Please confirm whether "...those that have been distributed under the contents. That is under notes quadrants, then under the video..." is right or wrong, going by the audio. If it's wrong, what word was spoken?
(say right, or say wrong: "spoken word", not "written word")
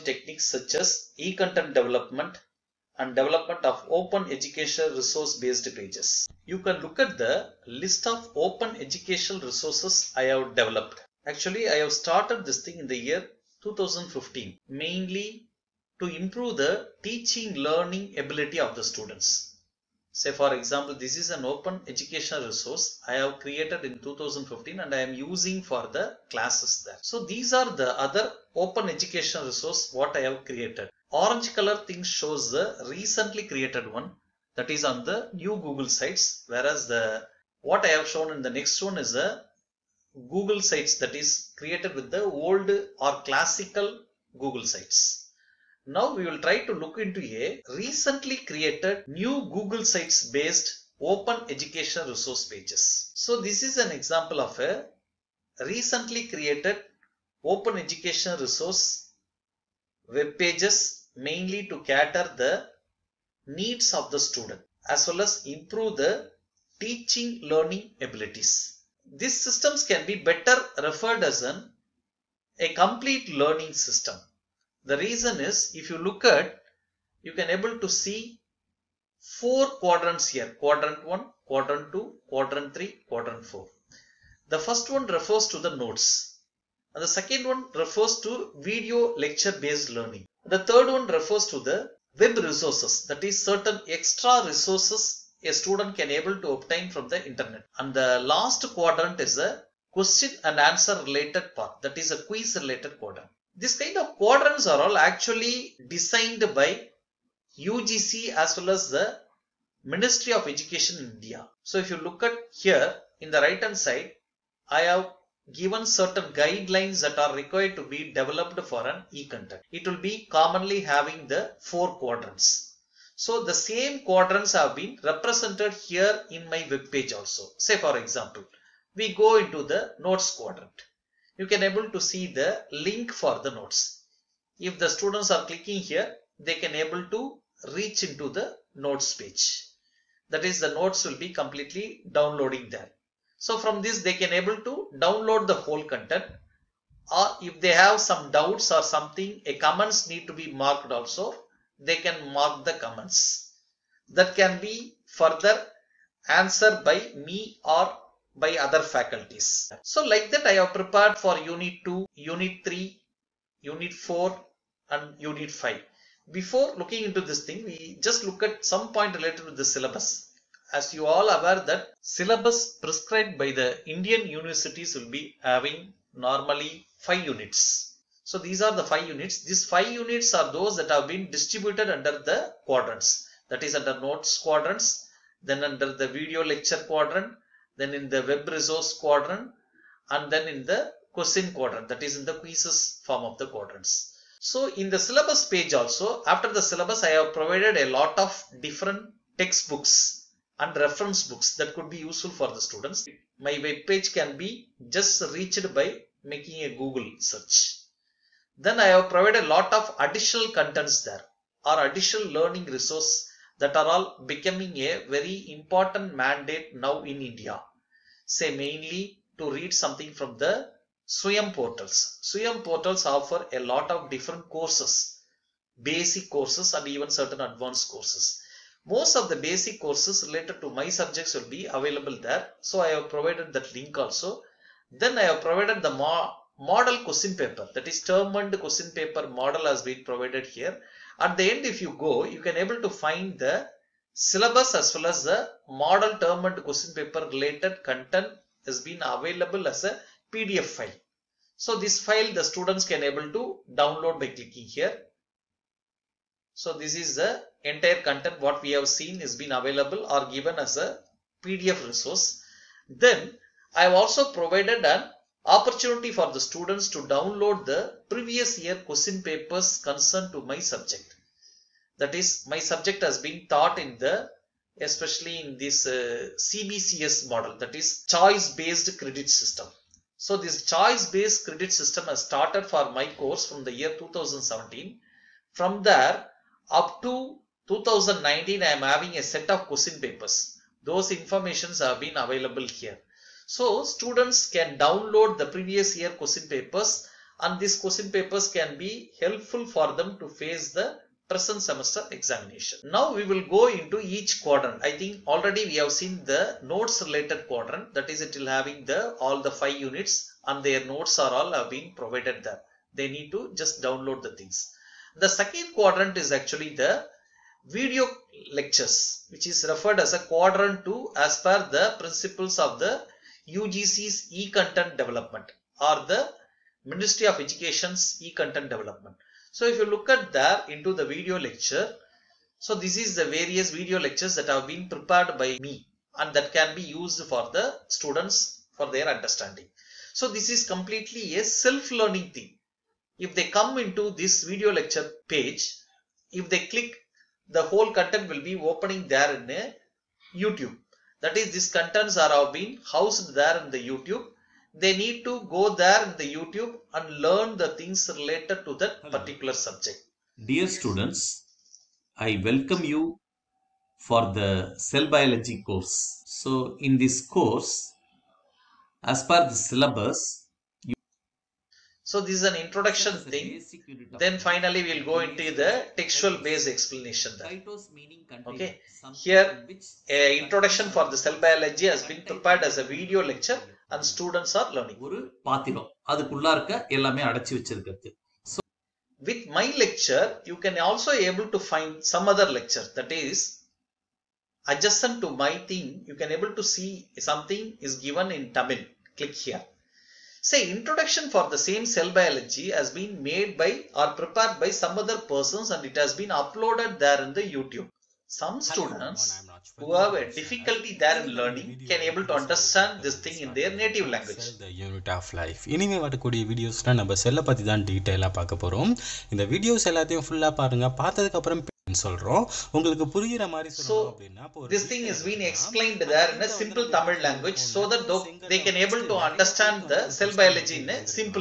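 wrong: "quadrants", not "contents".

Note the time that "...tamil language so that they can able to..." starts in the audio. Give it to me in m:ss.
7:06.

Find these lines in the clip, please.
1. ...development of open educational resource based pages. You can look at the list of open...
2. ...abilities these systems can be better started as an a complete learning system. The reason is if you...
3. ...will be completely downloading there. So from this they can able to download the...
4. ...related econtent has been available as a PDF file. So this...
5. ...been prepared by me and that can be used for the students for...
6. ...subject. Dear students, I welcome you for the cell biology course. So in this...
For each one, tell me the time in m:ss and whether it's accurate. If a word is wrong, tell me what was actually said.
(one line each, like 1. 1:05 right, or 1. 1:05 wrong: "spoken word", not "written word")
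1. 0:03 right
2. 1:08 wrong: "referred", not "started"
3. 2:21 right
4. 4:07 wrong: "content", not "econtent"
5. 5:34 right
6. 5:59 right.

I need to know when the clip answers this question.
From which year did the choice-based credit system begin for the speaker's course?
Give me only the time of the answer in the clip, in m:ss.
4:43.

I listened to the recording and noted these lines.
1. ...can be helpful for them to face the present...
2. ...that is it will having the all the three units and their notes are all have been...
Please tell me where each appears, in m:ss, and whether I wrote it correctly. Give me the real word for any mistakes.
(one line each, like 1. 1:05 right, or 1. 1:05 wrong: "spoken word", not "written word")
1. 4:58 right
2. 5:07 wrong: "five", not "three".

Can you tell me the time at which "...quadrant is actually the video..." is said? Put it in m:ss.
5:15.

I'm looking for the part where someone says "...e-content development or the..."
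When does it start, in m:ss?
5:24.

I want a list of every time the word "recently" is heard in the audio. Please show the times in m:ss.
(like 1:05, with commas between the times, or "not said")
0:32, 0:47, 0:55.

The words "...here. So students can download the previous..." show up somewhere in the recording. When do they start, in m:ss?
4:52.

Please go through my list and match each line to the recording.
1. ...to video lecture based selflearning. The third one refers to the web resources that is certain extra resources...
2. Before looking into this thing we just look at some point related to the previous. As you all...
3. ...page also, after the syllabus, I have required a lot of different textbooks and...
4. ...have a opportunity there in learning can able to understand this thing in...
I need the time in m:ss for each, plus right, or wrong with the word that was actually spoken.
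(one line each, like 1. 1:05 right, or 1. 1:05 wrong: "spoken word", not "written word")
1. 1:28 wrong: "learning", not "selflearning"
2. 2:46 wrong: "syllabus", not "previous"
3. 3:15 wrong: "provided", not "required"
4. 6:49 wrong: "difficulty", not "opportunity".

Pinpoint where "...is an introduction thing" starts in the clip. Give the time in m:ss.
6:12.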